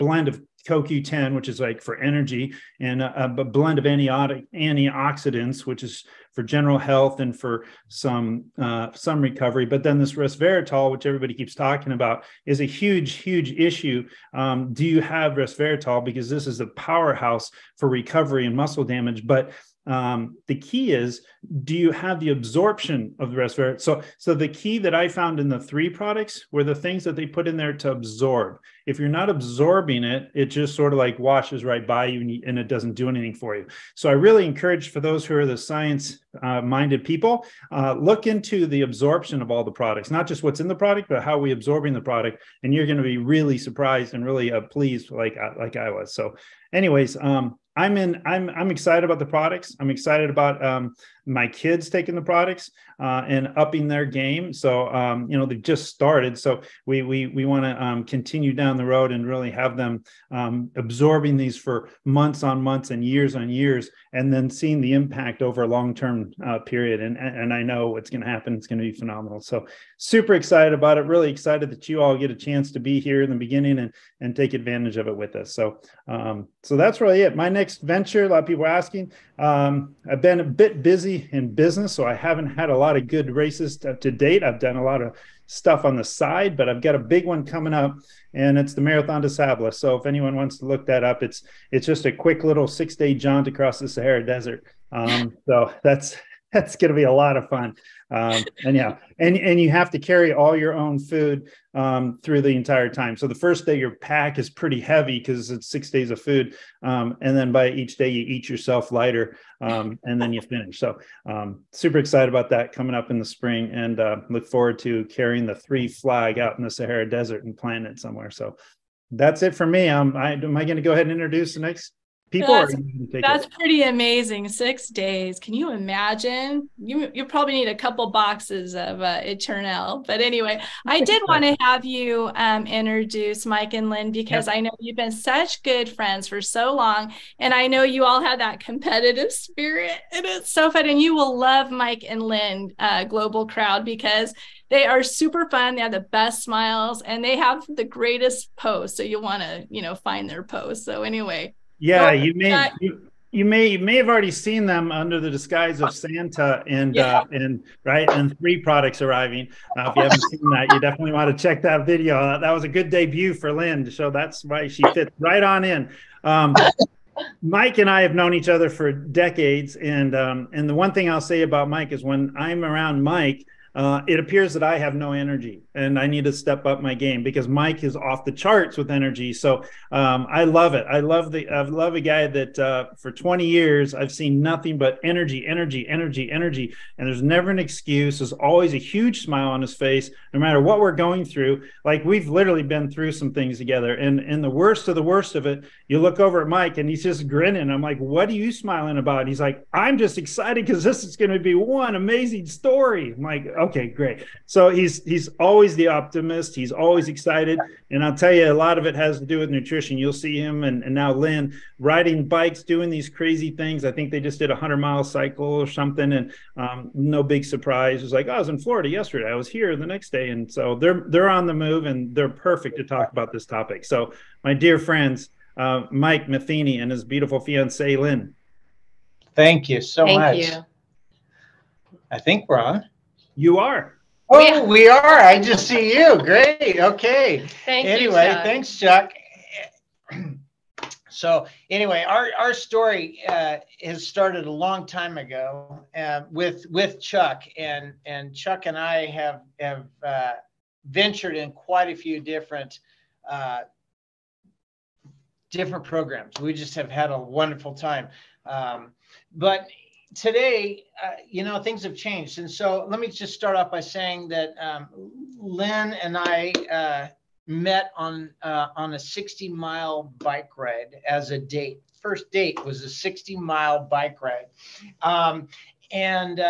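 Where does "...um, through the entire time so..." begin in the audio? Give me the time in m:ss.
1:41.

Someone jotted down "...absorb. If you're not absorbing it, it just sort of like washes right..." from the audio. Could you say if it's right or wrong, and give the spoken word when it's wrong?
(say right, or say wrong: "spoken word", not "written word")
right.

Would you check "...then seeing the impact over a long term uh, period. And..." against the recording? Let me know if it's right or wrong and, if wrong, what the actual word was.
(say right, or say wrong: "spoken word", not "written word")
right.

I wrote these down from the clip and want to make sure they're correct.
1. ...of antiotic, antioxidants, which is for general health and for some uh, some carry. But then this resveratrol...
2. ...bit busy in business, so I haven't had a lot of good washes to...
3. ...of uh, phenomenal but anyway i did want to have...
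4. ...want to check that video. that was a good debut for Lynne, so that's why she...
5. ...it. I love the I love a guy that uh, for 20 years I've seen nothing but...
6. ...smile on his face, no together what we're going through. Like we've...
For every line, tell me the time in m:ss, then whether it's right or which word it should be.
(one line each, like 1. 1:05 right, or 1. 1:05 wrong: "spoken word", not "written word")
1. 0:03 wrong: "recovery", not "carry"
2. 1:20 wrong: "races", not "washes"
3. 2:08 wrong: "eternal", not "phenomenal"
4. 2:41 right
5. 3:00 right
6. 3:09 wrong: "matter", not "together".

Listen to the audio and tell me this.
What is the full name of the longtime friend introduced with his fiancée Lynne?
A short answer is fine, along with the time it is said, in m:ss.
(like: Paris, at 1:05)
Mike Matheny, at 3:45.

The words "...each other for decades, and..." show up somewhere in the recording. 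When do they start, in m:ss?
2:48.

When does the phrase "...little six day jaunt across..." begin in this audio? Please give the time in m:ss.
1:32.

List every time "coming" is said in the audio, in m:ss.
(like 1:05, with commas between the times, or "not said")
1:27, 1:52.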